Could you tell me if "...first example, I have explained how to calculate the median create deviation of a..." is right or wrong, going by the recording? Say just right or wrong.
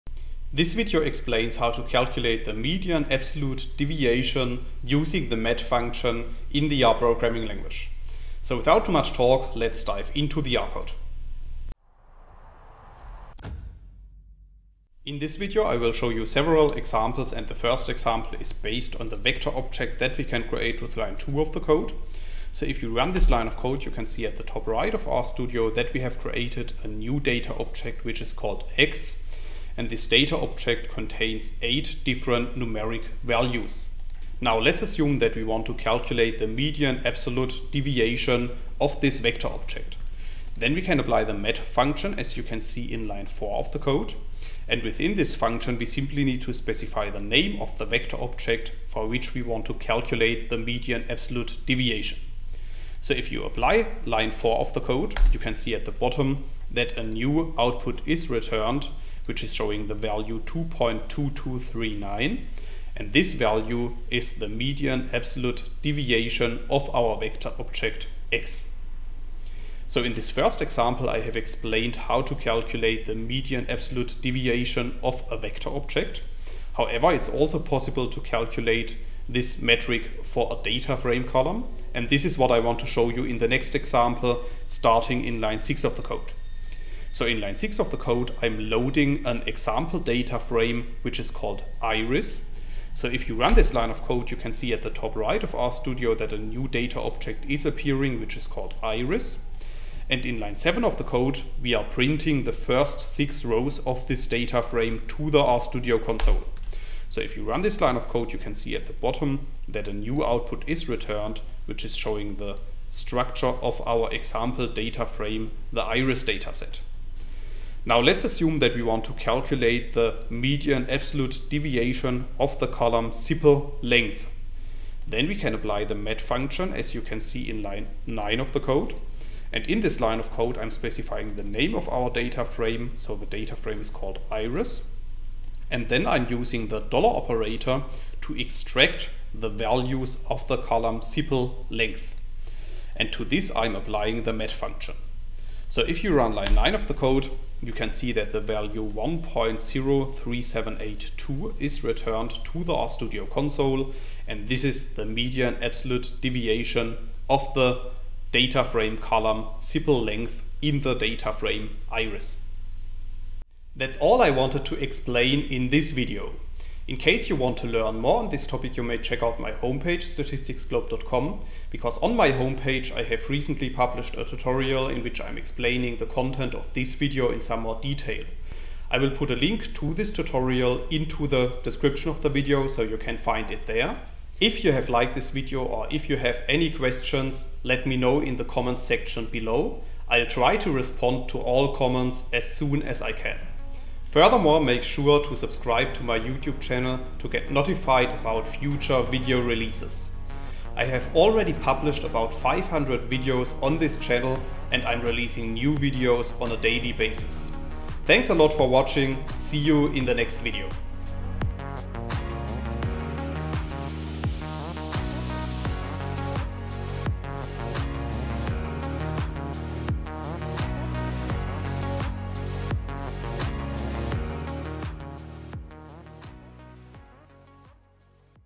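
wrong.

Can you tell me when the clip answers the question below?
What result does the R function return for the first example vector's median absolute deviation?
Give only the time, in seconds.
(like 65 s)
60 s.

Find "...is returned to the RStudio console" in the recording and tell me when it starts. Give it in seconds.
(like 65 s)
151 s.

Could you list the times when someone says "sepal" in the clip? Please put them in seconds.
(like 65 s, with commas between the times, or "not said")
123 s, 140 s, 159 s.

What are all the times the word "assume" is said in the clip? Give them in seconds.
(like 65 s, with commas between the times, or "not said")
34 s, 118 s.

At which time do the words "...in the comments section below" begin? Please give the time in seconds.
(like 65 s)
188 s.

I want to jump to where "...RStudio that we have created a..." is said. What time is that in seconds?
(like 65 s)
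25 s.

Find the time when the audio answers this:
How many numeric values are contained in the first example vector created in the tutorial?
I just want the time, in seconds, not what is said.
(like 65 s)
31 s.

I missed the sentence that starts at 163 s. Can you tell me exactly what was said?
That's all I wanted to explain in this video.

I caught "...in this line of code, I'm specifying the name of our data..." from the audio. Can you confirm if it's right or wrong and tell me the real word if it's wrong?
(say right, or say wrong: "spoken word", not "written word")
right.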